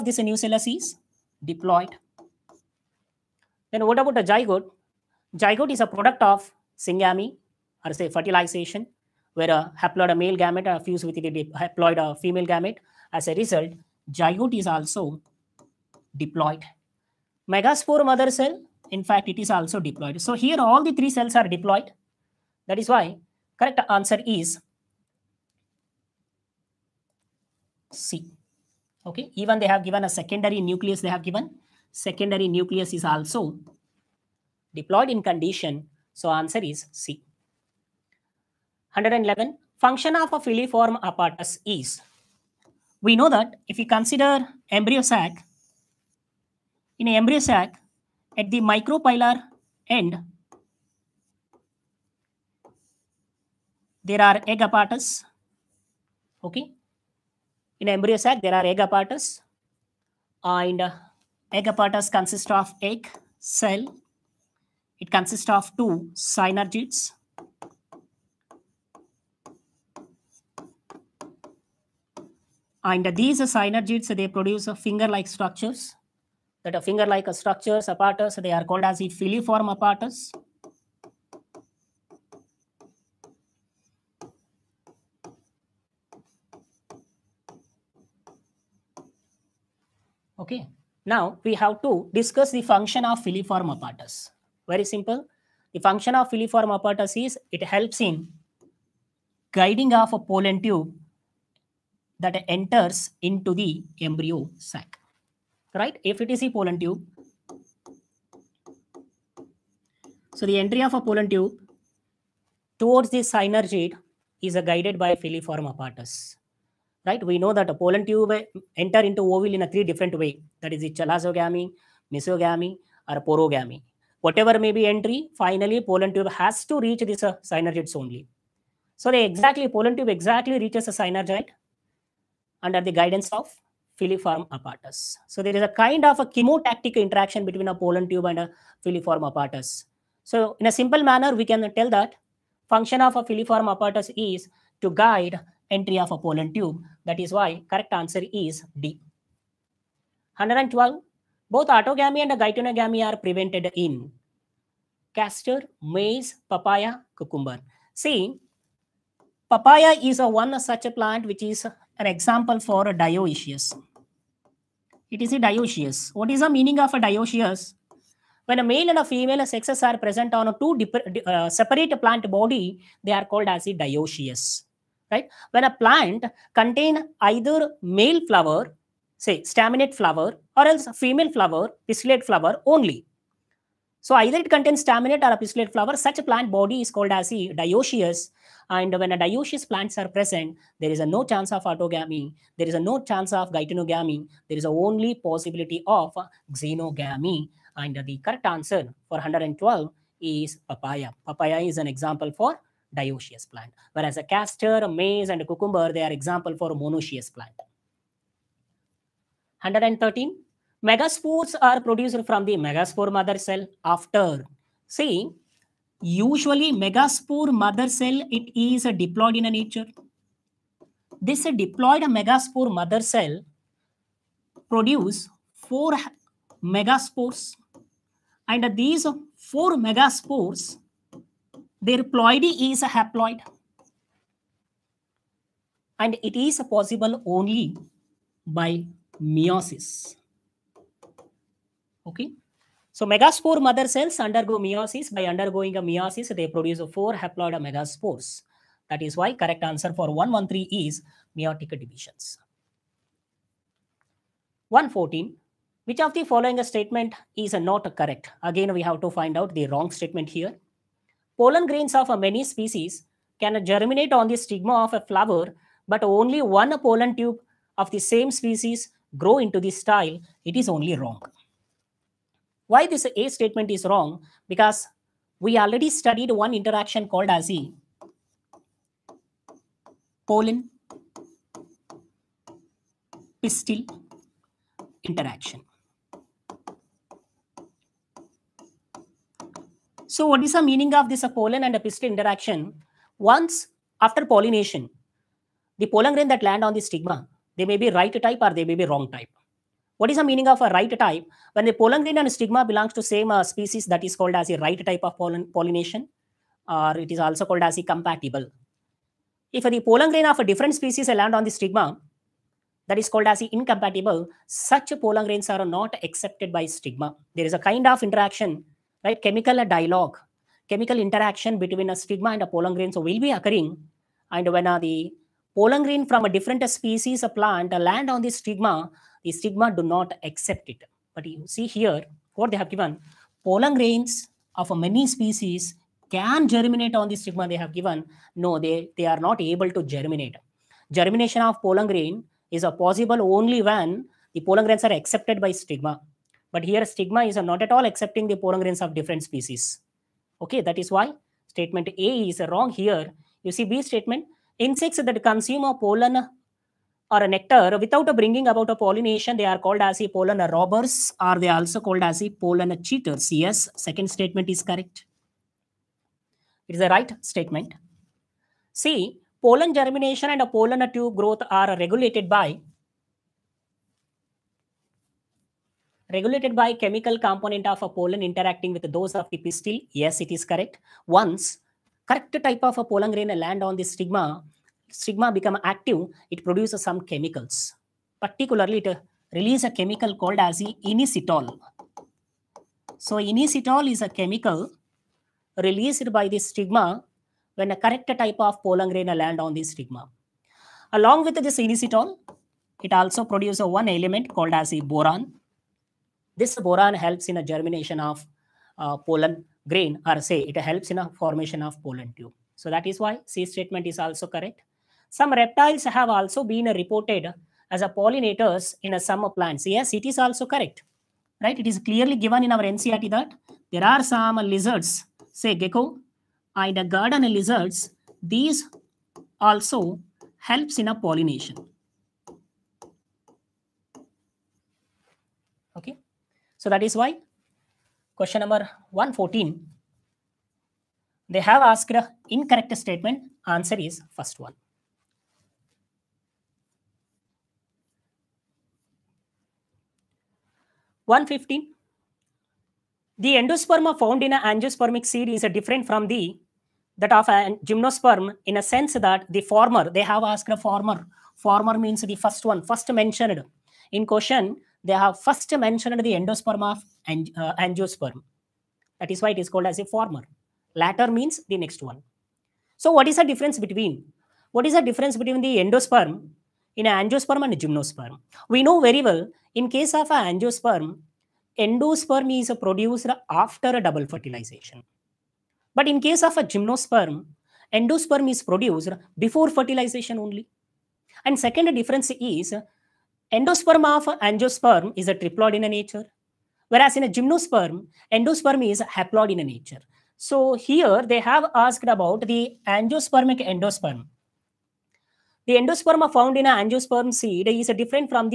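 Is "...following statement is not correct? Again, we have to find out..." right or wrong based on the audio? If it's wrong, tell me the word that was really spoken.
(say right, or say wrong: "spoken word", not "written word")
right.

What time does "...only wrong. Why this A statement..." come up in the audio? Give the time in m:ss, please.
4:30.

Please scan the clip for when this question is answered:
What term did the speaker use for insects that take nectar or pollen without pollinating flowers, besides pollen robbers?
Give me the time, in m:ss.
6:02.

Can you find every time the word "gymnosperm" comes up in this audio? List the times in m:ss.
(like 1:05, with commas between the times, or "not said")
7:37, 7:57, 8:06, 8:17.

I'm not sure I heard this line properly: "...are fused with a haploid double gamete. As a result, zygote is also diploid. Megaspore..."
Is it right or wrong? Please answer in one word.
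wrong.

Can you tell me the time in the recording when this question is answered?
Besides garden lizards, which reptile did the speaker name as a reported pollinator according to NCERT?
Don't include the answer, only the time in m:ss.
7:05.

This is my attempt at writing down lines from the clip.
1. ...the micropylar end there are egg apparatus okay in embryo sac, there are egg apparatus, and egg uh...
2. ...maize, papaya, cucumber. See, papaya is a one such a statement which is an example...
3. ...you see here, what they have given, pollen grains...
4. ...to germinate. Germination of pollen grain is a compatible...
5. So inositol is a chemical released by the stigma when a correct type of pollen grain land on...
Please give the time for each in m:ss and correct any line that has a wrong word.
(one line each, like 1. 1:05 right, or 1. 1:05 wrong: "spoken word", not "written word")
1. 0:48 right
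2. 2:35 wrong: "plant", not "statement"
3. 5:31 right
4. 5:39 wrong: "possible", not "compatible"
5. 6:33 right.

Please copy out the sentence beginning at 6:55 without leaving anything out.
Some reptiles have also been reported as a pollinators in a summer plants.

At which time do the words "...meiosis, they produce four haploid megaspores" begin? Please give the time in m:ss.
4:05.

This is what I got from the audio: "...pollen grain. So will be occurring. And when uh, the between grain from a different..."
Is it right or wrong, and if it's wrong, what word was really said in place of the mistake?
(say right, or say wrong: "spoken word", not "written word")
wrong: "pollen", not "between".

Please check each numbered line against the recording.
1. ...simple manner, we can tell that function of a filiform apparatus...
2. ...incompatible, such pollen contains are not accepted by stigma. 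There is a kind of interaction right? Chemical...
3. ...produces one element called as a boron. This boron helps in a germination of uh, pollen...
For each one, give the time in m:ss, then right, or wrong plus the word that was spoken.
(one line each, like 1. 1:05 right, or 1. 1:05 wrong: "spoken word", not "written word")
1. 2:20 right
2. 5:13 wrong: "grains", not "contains"
3. 6:43 right.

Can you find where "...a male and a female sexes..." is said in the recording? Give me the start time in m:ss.
2:48.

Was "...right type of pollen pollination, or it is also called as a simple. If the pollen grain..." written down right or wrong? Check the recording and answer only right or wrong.
wrong.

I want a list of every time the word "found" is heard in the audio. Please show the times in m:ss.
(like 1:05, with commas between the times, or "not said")
7:33, 8:26.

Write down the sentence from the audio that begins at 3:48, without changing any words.
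And these four megaspores their ploidy is a haploid.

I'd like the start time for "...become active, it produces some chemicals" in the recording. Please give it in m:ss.
6:25.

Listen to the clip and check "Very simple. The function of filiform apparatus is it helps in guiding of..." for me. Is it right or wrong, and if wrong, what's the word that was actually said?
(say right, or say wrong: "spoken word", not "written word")
right.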